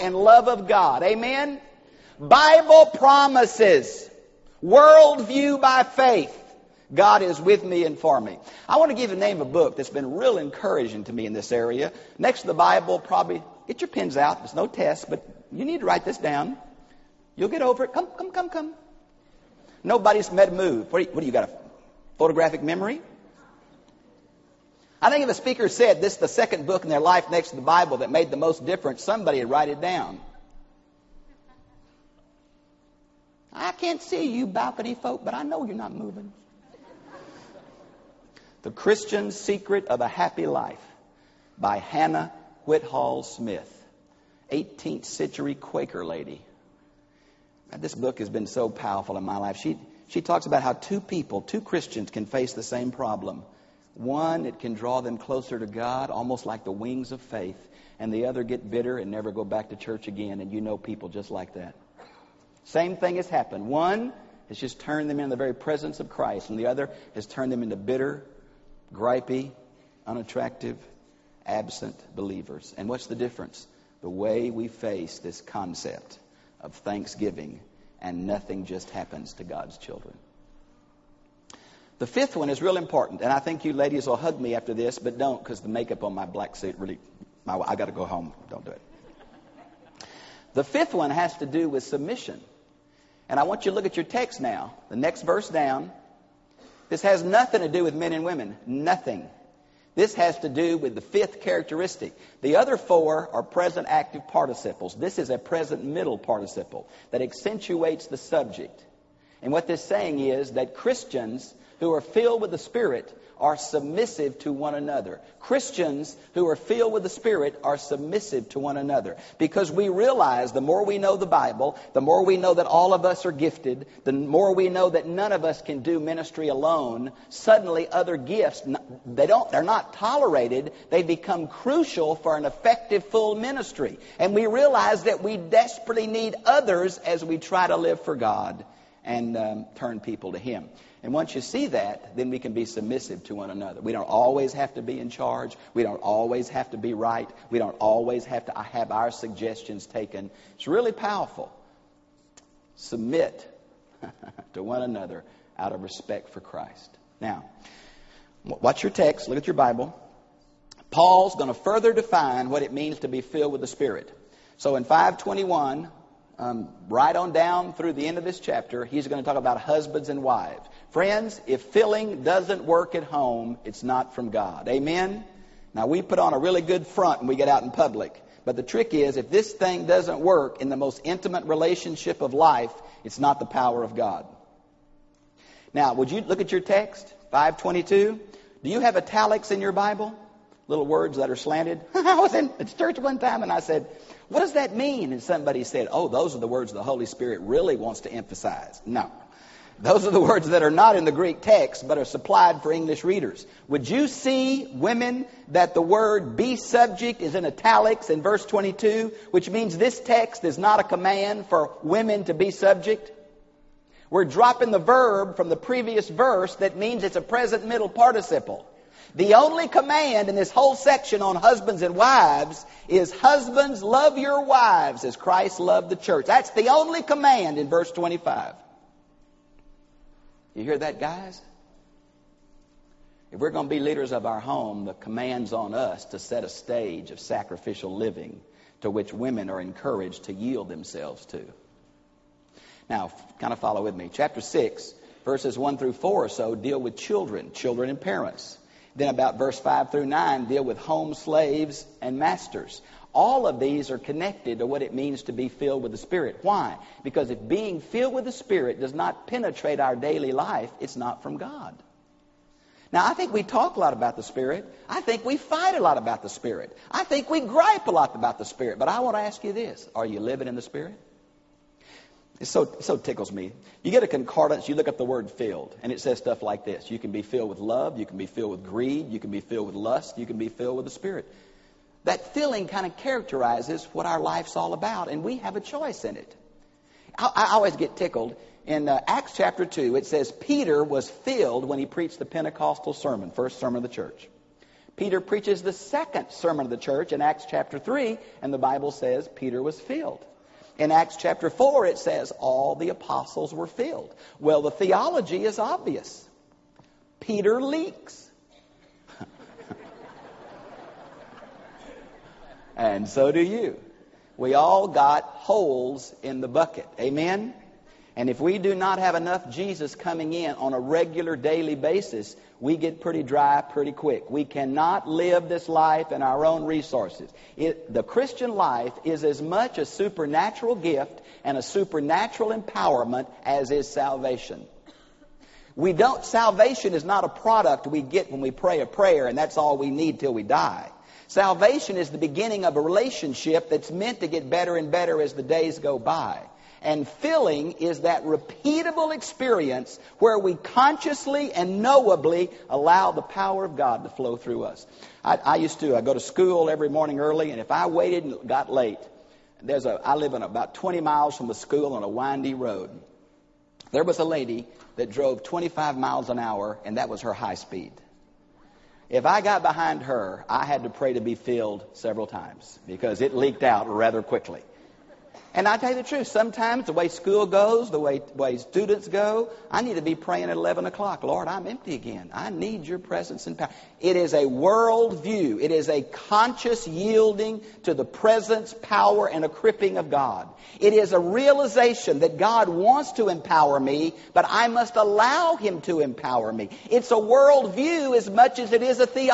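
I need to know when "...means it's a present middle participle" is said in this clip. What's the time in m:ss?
3:36.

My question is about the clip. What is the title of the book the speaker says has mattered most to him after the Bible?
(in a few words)
The Christian Secret of a Happy Life.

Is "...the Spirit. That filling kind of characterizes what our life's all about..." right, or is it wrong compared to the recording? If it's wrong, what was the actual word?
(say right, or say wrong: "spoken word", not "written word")
right.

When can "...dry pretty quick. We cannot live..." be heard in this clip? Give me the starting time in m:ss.
5:23.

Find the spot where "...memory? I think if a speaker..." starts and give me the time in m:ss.
0:22.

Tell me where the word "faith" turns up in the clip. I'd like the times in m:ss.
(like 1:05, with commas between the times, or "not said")
0:05, 0:57.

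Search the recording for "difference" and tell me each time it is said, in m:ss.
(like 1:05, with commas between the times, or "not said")
0:28, 1:13.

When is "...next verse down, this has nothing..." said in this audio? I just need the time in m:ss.
1:34.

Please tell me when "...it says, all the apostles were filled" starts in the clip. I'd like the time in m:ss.
5:01.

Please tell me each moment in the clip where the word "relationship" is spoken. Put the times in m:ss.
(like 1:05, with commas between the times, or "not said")
3:01, 5:42.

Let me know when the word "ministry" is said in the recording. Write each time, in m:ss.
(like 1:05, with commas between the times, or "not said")
2:05, 2:13.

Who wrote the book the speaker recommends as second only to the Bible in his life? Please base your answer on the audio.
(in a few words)
Hannah Whitall Smith.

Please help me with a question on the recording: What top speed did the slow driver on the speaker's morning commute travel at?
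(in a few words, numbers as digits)
25 miles an hour.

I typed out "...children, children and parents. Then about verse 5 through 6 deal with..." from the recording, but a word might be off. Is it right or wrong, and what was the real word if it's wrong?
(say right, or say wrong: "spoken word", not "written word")
wrong: "9", not "6".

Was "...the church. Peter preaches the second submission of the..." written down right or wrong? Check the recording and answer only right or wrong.
wrong.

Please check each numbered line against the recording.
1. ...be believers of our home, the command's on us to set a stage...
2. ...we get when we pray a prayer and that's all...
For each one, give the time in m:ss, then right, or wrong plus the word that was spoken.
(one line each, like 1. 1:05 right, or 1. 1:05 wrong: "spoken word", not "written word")
1. 3:53 wrong: "leaders", not "believers"
2. 5:37 right.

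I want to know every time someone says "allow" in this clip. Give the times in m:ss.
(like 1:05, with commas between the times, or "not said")
5:52, 6:34.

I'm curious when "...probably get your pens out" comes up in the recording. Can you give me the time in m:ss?
0:12.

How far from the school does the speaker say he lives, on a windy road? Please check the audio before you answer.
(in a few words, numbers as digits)
20 miles.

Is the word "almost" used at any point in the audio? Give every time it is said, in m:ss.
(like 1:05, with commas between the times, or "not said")
0:56.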